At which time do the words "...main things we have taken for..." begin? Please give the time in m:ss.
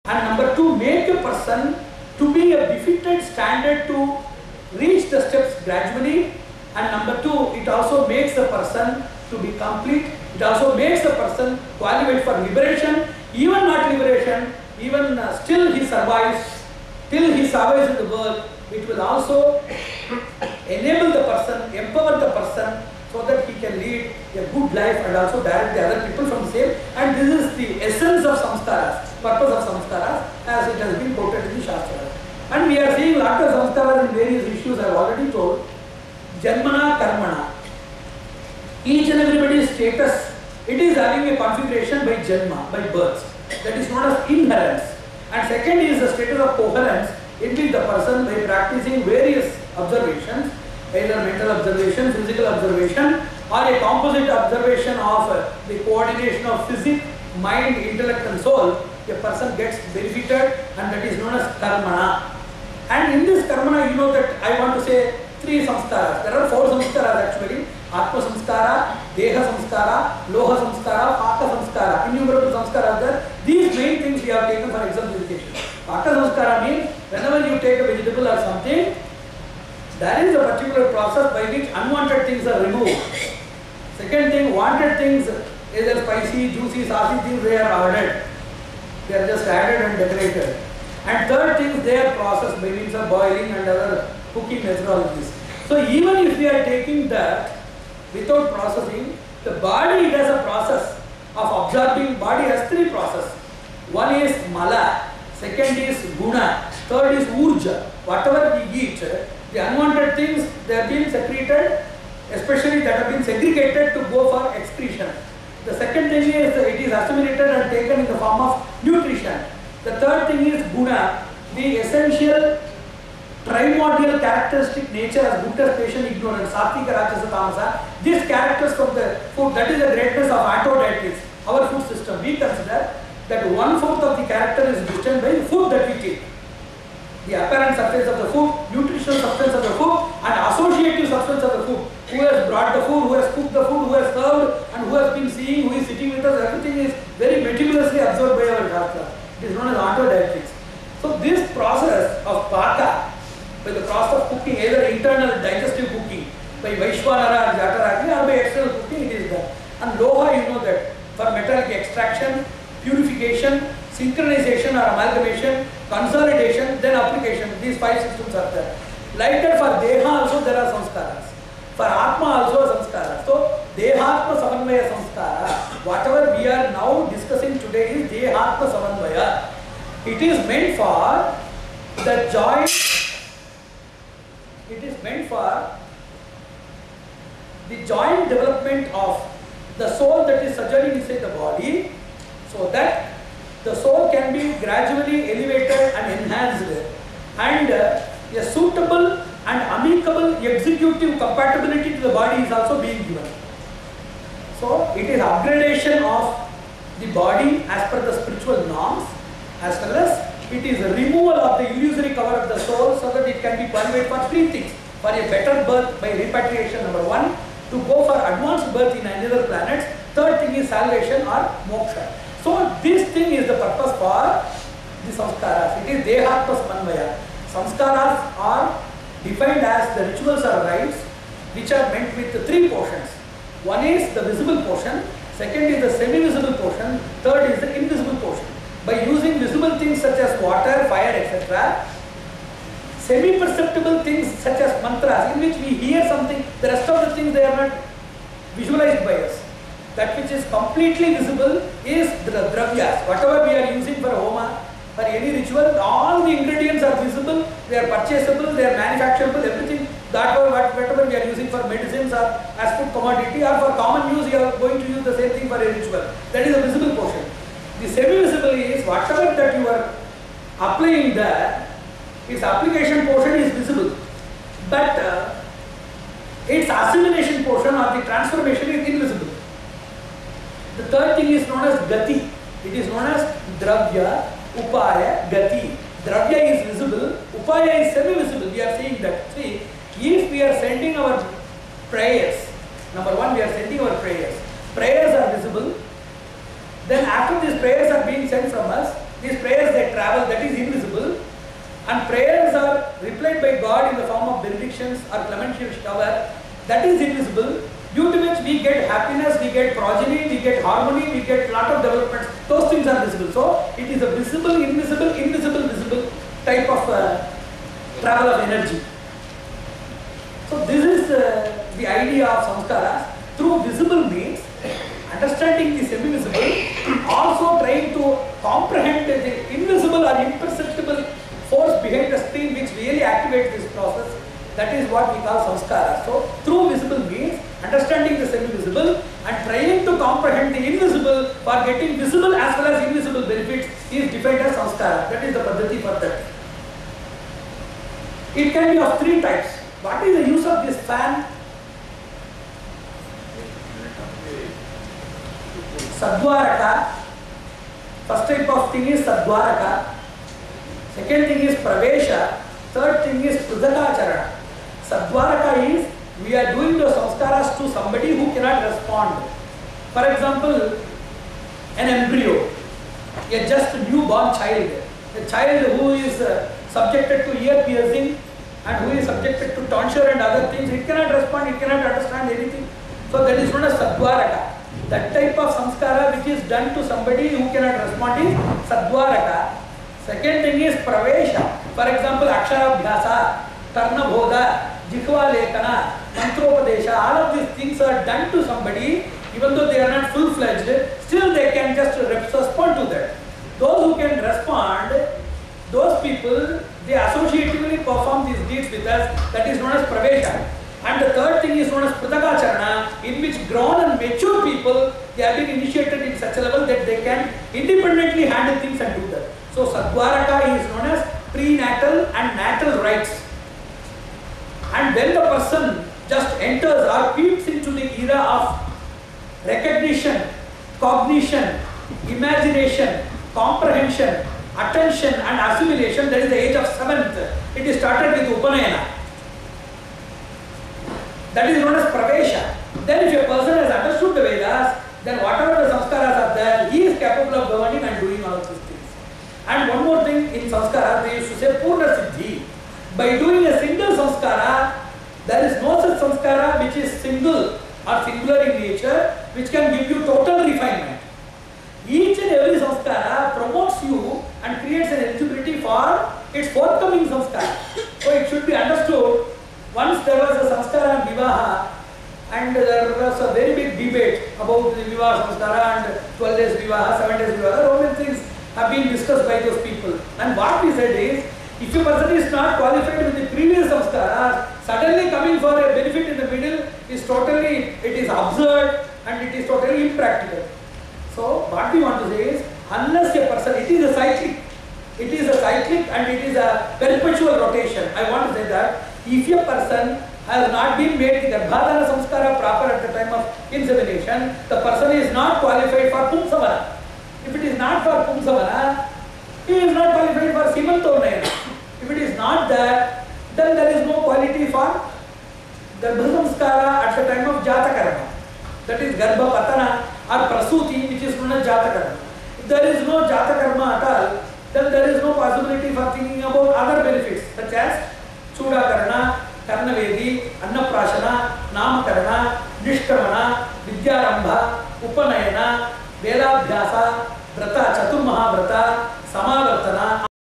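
1:13.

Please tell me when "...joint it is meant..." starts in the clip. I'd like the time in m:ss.
3:02.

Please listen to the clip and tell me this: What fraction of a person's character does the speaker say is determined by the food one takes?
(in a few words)
1/4.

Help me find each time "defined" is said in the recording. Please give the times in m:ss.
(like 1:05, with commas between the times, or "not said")
3:49, 5:44.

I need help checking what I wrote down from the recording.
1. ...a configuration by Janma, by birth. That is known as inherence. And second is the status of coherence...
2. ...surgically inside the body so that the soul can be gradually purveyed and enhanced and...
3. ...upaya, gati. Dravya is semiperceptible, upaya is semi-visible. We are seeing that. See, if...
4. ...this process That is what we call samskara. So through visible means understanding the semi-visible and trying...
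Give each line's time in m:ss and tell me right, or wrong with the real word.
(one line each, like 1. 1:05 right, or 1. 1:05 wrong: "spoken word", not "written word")
1. 0:41 right
2. 3:10 wrong: "elevated", not "purveyed"
3. 4:44 wrong: "visible", not "semiperceptible"
4. 5:33 right.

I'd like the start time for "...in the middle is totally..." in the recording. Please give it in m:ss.
8:06.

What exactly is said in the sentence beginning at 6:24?
That type of samskara which is done to somebody who cannot respond is Sadvaraka.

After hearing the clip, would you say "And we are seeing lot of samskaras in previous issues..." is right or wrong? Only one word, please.
wrong.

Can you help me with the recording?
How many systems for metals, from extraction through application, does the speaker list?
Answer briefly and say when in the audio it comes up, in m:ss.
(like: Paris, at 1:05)
5, at 2:47.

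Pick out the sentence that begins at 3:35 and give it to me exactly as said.
For a better birth by repatriation, number one.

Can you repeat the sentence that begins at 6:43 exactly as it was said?
Those who can respond, those people, they associatively perform these deeds with us, that is known as pravesha.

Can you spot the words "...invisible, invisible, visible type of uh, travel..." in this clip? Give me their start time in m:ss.
5:14.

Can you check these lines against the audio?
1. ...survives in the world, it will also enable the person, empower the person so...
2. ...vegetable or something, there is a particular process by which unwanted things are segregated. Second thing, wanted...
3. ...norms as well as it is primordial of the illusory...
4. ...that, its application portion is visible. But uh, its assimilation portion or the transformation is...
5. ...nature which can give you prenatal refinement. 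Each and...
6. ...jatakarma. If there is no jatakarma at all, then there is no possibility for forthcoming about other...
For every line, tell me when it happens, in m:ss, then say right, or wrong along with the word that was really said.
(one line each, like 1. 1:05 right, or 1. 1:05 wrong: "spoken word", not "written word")
1. 0:17 right
2. 1:17 wrong: "removed", not "segregated"
3. 3:28 wrong: "removal", not "primordial"
4. 4:31 right
5. 7:38 wrong: "total", not "prenatal"
6. 8:41 wrong: "thinking", not "forthcoming".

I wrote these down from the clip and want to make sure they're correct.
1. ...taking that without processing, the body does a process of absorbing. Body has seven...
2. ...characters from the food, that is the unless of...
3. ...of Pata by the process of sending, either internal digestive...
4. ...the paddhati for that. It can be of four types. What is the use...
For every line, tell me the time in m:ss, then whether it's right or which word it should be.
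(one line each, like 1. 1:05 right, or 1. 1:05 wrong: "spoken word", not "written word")
1. 1:36 wrong: "three", not "seven"
2. 2:08 wrong: "greatness", not "unless"
3. 2:32 wrong: "cooking", not "sending"
4. 5:45 wrong: "three", not "four".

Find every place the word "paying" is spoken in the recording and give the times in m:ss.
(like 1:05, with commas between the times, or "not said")
not said.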